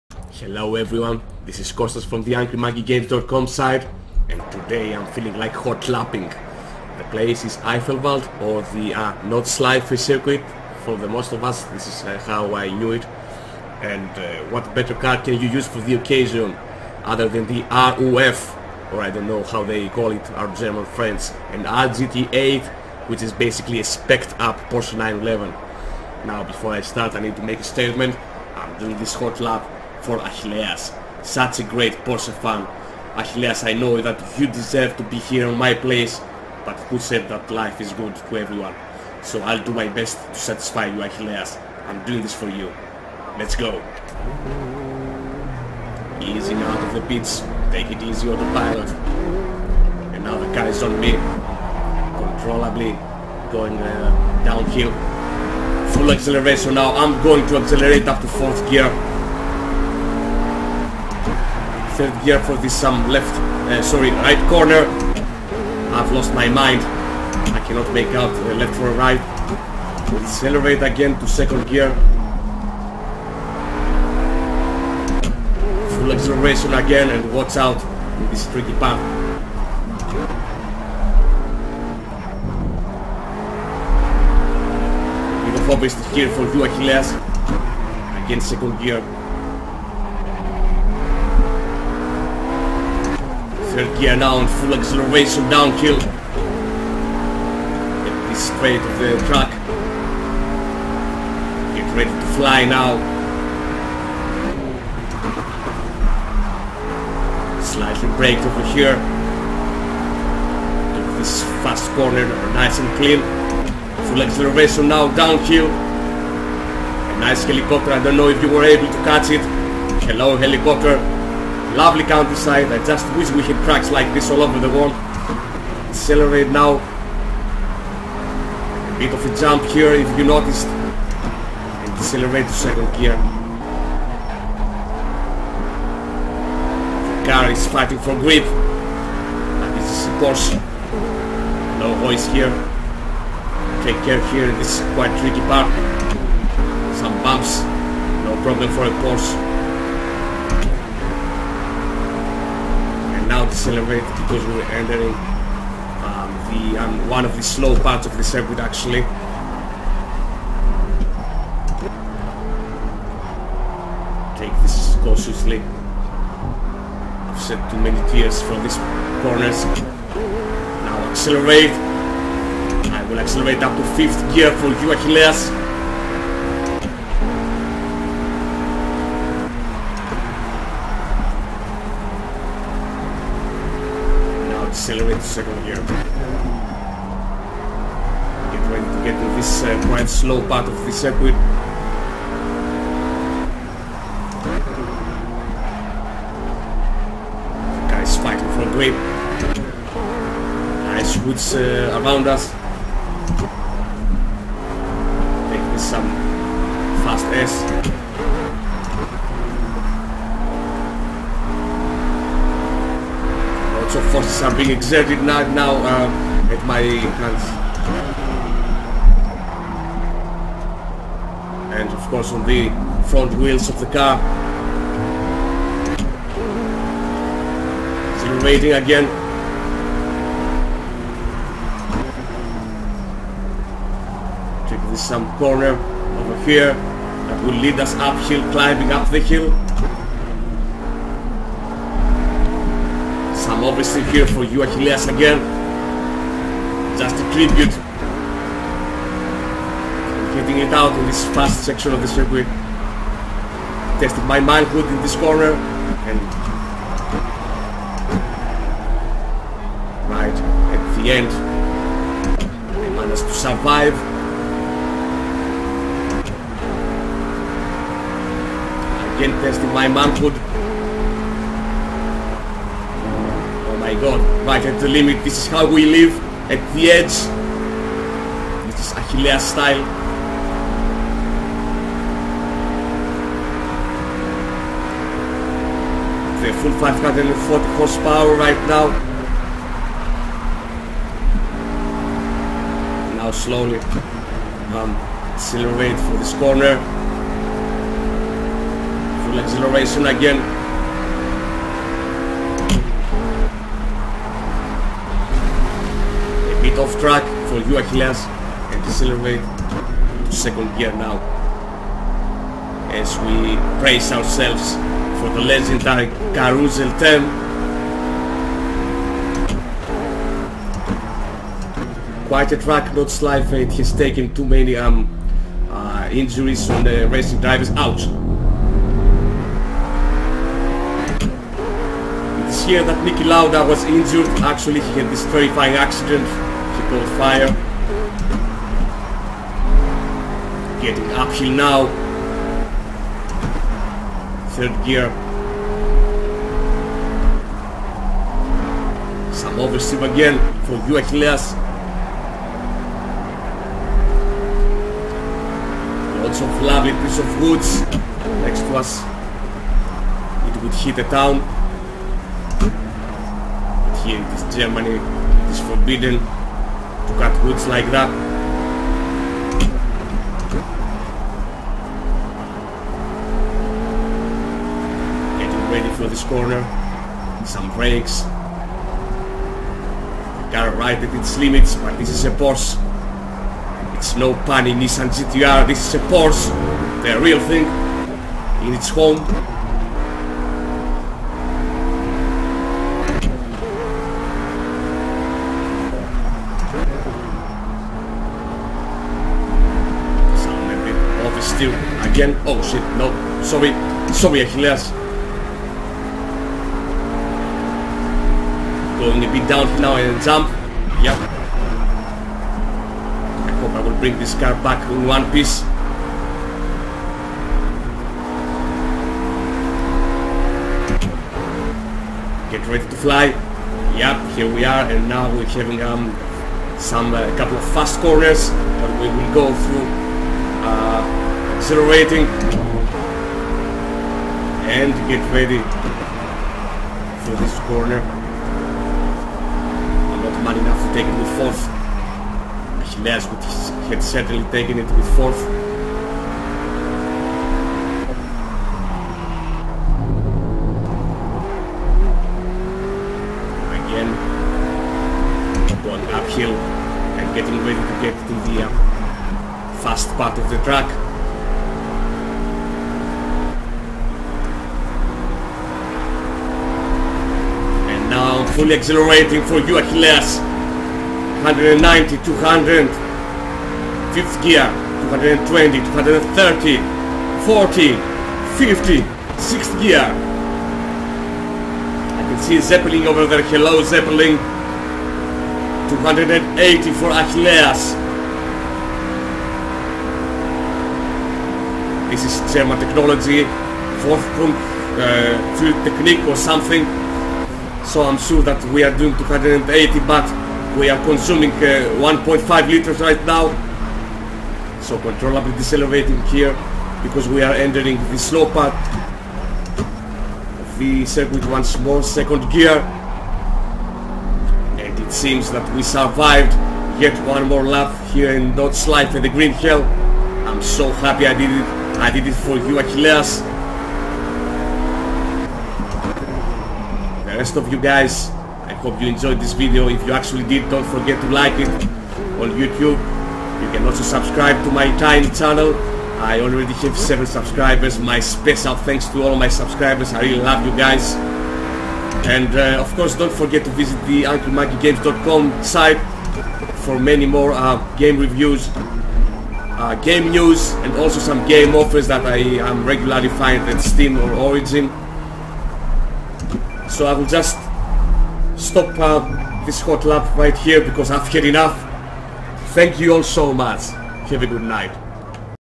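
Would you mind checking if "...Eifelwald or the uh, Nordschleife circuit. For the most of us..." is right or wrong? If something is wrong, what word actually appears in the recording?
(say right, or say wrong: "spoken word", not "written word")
right.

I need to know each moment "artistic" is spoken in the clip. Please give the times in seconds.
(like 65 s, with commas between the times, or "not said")
not said.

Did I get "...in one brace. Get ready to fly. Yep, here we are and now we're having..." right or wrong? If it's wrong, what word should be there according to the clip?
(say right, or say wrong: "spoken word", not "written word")
wrong: "piece", not "brace".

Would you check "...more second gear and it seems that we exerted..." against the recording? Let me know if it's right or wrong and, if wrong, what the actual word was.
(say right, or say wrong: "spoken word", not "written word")
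wrong: "survived", not "exerted".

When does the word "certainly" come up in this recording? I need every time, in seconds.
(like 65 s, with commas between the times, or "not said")
444 s.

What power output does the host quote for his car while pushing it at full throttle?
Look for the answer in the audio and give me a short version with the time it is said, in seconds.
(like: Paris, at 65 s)
540 horsepower, at 286 s.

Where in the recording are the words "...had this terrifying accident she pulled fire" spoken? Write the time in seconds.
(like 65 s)
335 s.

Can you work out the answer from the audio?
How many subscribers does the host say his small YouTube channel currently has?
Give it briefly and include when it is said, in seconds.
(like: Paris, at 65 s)
7, at 536 s.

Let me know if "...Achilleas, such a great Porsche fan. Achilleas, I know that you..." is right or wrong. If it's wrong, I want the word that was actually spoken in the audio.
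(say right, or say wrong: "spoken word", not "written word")
right.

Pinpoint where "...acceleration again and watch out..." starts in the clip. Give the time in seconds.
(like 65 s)
76 s.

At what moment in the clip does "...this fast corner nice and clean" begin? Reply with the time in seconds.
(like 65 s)
111 s.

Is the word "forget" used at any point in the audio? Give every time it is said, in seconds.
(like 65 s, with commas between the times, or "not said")
530 s, 543 s.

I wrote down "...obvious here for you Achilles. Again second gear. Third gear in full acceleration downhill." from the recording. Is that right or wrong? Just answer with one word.
right.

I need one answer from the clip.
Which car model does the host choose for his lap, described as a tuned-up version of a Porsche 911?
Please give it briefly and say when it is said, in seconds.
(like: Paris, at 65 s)
RUF RGT8, at 21 s.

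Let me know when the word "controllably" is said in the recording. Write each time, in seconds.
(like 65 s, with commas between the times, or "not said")
52 s, 504 s.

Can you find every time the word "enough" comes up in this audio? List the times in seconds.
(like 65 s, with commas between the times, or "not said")
440 s, 561 s.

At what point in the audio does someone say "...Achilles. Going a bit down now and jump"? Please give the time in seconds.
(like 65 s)
404 s.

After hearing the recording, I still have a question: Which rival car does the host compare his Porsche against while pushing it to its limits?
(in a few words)
Nissan GTR.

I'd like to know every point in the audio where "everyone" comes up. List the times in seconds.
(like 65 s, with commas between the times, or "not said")
0 s, 38 s.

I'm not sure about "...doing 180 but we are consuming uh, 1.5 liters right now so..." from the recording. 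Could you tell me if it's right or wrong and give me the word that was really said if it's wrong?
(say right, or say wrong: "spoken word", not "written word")
wrong: "280", not "180".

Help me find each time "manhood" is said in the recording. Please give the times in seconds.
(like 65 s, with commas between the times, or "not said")
254 s, 269 s.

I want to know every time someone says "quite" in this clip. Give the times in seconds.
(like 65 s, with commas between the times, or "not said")
144 s, 189 s, 322 s.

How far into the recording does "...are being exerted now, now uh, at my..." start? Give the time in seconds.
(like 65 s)
214 s.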